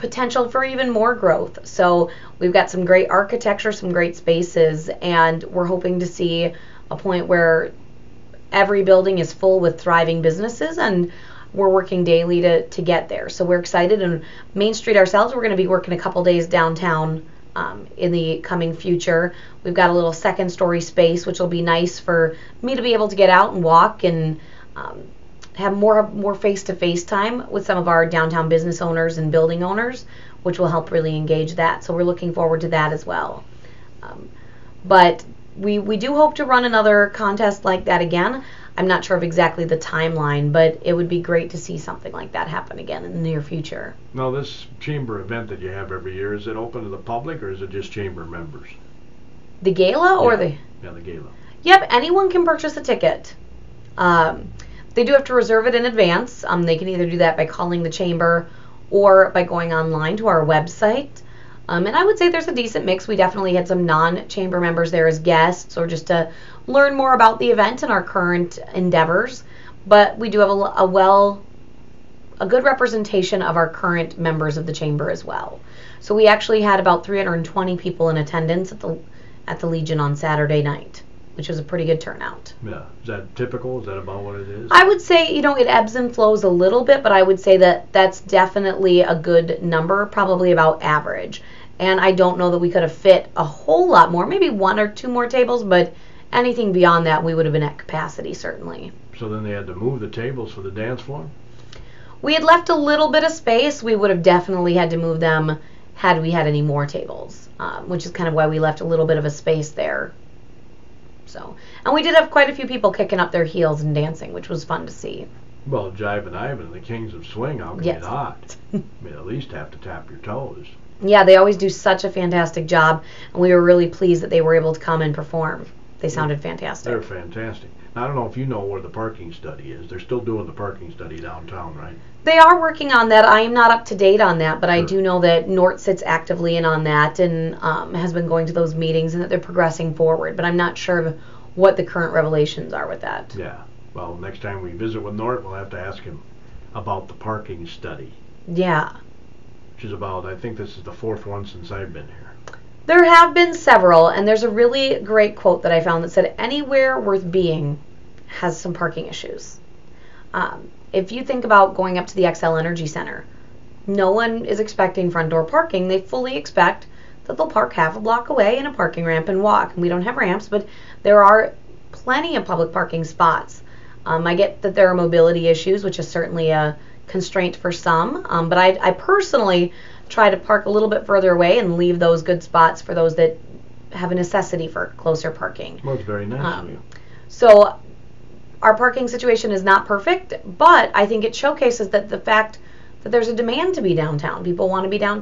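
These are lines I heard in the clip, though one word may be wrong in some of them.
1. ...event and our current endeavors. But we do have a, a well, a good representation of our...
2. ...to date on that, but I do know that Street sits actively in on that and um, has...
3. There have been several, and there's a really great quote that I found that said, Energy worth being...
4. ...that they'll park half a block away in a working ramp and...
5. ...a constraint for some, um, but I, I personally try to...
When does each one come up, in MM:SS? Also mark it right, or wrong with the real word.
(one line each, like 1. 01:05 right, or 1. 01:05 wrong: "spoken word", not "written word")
1. 01:07 right
2. 02:13 wrong: "Nort", not "Street"
3. 02:32 wrong: "Anywhere", not "Energy"
4. 02:47 wrong: "parking", not "working"
5. 02:56 right.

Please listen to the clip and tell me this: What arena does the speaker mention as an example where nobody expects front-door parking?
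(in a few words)
Xcel Energy Center.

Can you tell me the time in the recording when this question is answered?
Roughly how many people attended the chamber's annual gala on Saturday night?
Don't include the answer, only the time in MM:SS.
01:17.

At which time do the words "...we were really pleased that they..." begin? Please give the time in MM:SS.
02:03.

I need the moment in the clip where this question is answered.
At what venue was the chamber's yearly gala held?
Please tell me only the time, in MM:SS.
01:19.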